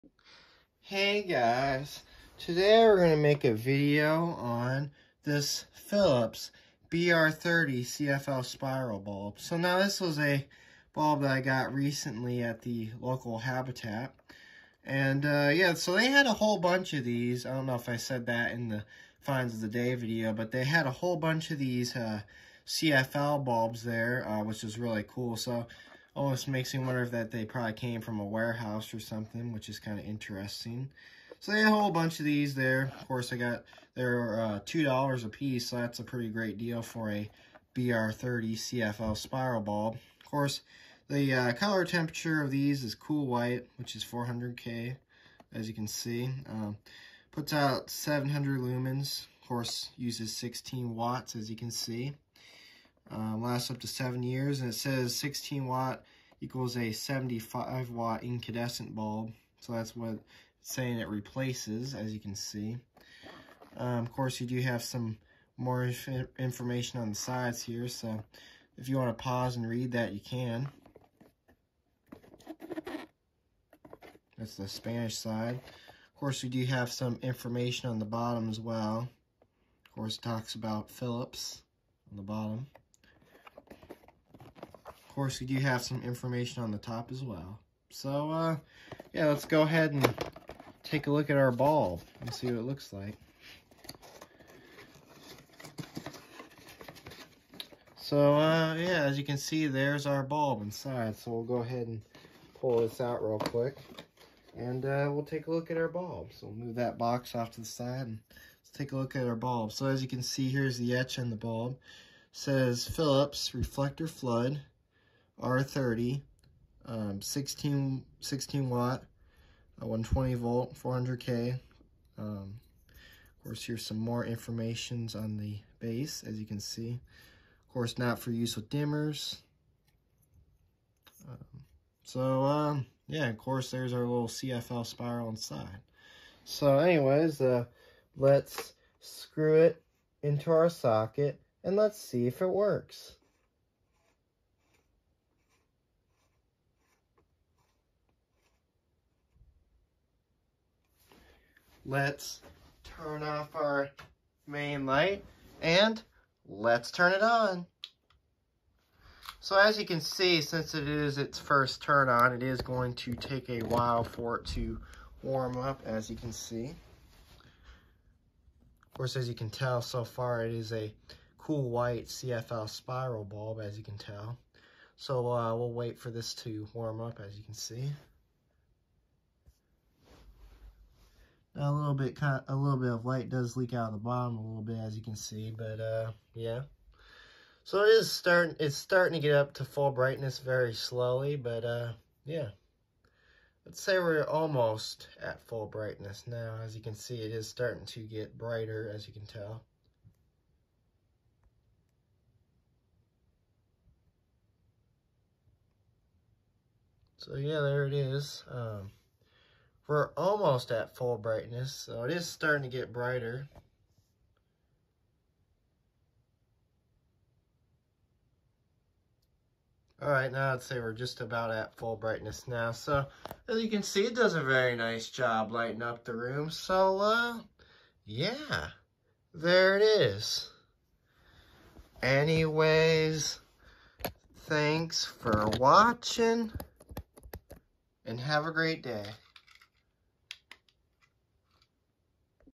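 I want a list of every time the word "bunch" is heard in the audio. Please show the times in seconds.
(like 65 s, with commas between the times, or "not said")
16 s, 21 s, 31 s.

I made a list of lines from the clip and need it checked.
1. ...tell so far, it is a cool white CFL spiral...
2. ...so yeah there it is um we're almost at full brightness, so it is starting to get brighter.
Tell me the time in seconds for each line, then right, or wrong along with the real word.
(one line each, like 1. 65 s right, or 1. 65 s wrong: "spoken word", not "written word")
1. 169 s right
2. 207 s right.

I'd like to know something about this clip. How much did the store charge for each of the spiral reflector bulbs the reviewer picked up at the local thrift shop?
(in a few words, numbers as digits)
$2.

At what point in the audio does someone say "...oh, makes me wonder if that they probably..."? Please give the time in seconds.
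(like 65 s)
26 s.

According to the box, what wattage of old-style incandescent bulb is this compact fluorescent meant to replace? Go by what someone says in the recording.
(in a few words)
75 watt.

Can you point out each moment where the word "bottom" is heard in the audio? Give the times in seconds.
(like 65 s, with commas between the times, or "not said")
78 s, 82 s, 183 s.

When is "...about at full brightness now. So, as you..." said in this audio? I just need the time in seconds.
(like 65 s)
221 s.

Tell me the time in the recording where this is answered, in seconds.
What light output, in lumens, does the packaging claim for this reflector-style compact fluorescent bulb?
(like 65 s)
47 s.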